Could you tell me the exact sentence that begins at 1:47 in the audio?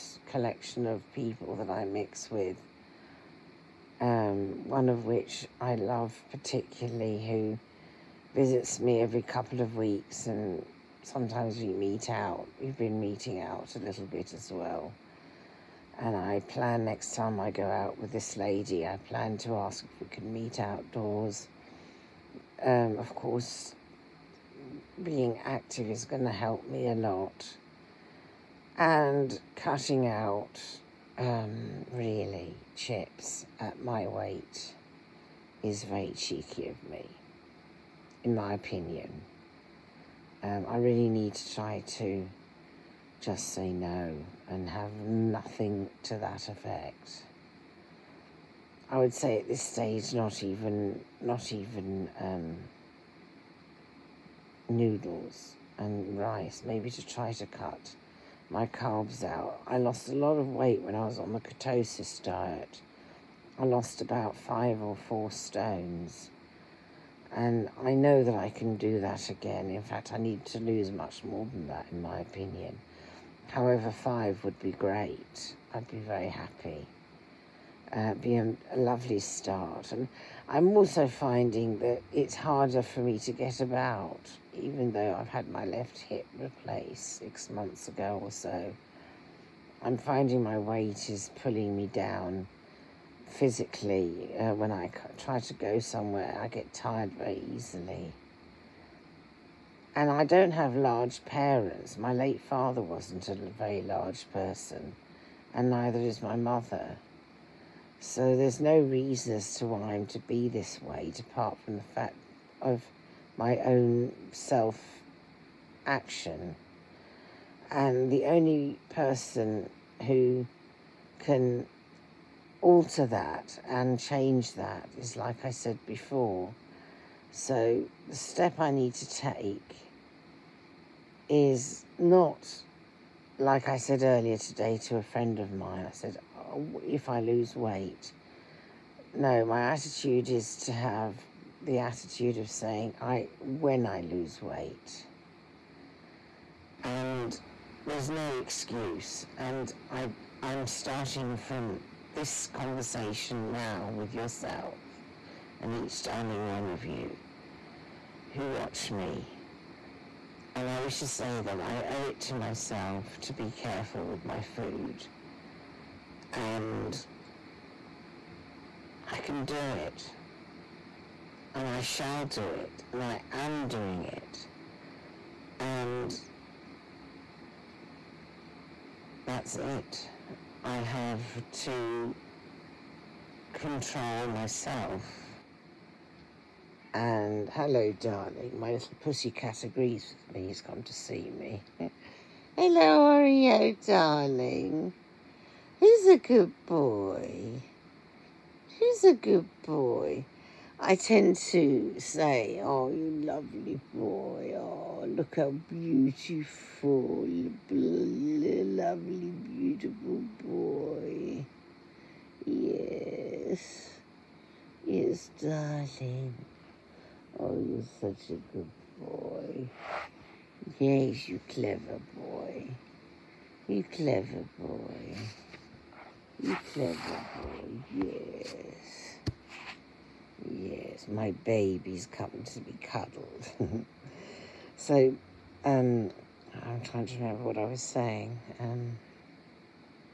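So there's no reason as to why I'm to be this weight, apart from the fact of my own self action.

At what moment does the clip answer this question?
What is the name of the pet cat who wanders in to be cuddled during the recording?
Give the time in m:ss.
3:13.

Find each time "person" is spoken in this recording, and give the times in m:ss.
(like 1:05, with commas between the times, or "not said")
1:44, 1:58.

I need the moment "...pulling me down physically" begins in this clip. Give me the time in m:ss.
1:31.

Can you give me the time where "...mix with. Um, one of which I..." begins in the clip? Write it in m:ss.
0:01.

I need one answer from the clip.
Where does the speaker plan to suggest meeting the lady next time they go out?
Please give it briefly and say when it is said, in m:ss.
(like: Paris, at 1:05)
Outdoors, at 0:20.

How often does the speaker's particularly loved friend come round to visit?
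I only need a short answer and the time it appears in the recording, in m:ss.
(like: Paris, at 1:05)
Every couple of weeks, at 0:09.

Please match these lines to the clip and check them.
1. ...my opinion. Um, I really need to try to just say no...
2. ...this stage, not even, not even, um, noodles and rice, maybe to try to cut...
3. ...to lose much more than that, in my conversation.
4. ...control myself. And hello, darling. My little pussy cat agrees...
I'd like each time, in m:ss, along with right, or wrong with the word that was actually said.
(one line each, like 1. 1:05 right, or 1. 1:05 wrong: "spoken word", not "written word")
1. 0:38 right
2. 0:49 right
3. 1:10 wrong: "opinion", not "conversation"
4. 3:03 right.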